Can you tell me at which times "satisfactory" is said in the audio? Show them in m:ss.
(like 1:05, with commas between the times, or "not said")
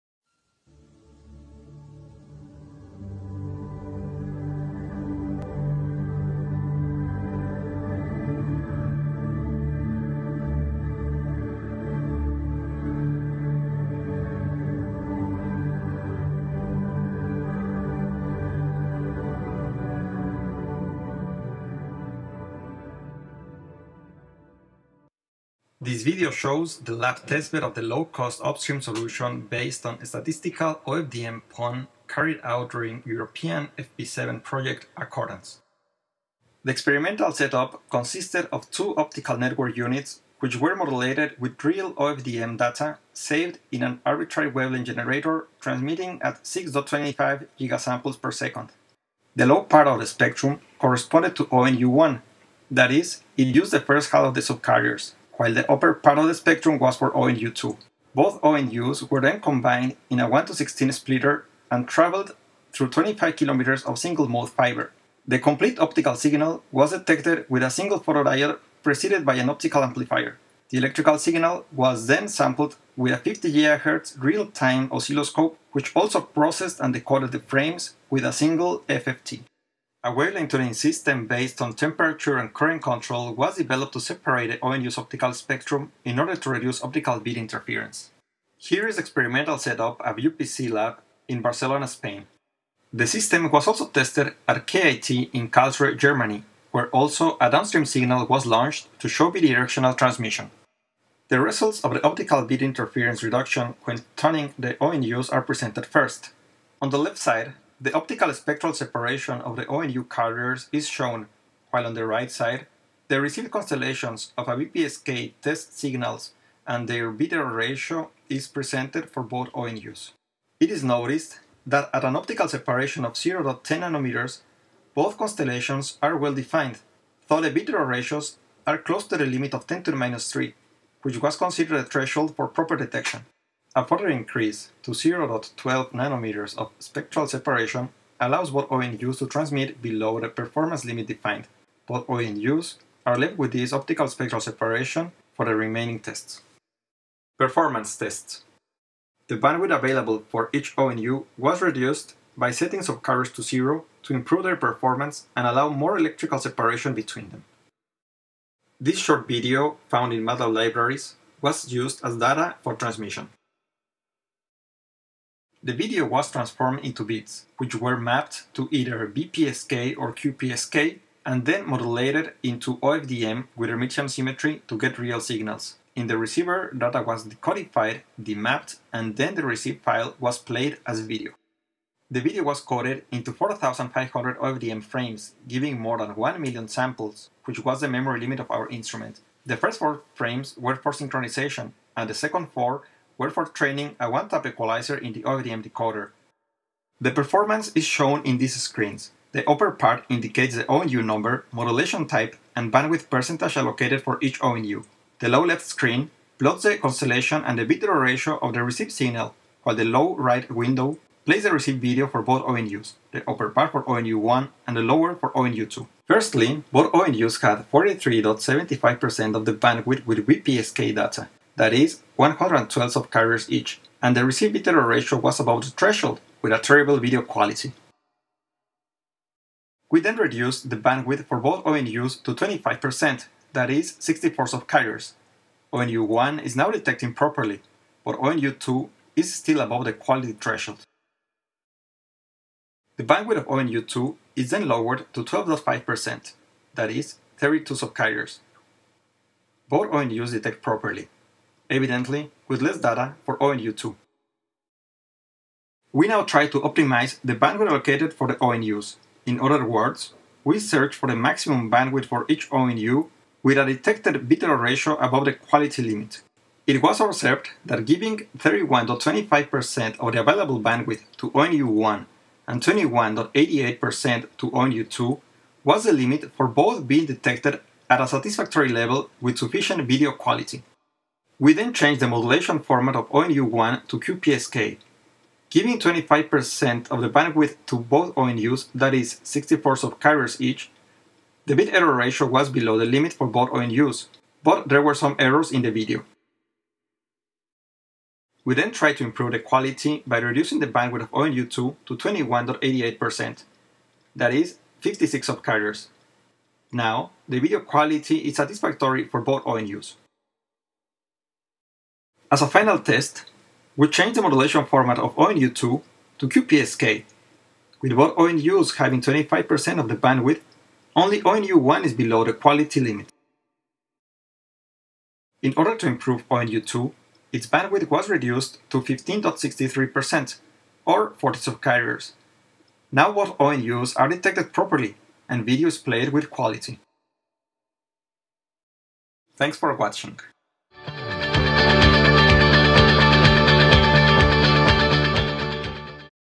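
4:38, 5:08.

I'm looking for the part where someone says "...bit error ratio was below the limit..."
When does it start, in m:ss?
4:51.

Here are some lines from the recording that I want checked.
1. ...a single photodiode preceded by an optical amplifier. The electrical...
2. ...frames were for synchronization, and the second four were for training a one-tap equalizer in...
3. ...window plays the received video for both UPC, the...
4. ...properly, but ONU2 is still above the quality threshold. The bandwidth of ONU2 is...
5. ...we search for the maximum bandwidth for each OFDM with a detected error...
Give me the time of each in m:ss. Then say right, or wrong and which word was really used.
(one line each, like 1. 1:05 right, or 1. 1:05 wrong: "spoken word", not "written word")
1. 1:07 right
2. 3:10 right
3. 3:30 wrong: "ONUs", not "UPC"
4. 3:57 right
5. 4:20 wrong: "ONU", not "OFDM".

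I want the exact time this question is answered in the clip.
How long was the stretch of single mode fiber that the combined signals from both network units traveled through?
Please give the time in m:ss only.
1:02.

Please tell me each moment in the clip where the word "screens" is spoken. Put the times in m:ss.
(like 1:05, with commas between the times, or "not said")
3:18, 3:25.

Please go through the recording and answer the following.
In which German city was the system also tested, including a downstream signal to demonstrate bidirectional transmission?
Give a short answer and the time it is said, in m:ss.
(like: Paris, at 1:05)
Karlsruhe, at 1:35.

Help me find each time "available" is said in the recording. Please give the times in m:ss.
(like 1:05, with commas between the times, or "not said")
2:29, 4:30.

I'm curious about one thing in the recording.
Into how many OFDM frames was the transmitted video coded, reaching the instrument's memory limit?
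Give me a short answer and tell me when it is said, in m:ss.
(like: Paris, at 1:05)
4,500, at 3:03.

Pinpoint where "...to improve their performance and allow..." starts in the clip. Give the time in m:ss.
2:34.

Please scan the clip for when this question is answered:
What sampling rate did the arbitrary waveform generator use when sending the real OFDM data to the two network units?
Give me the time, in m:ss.
0:46.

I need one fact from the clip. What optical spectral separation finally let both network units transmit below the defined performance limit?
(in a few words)
0.12 nanometers.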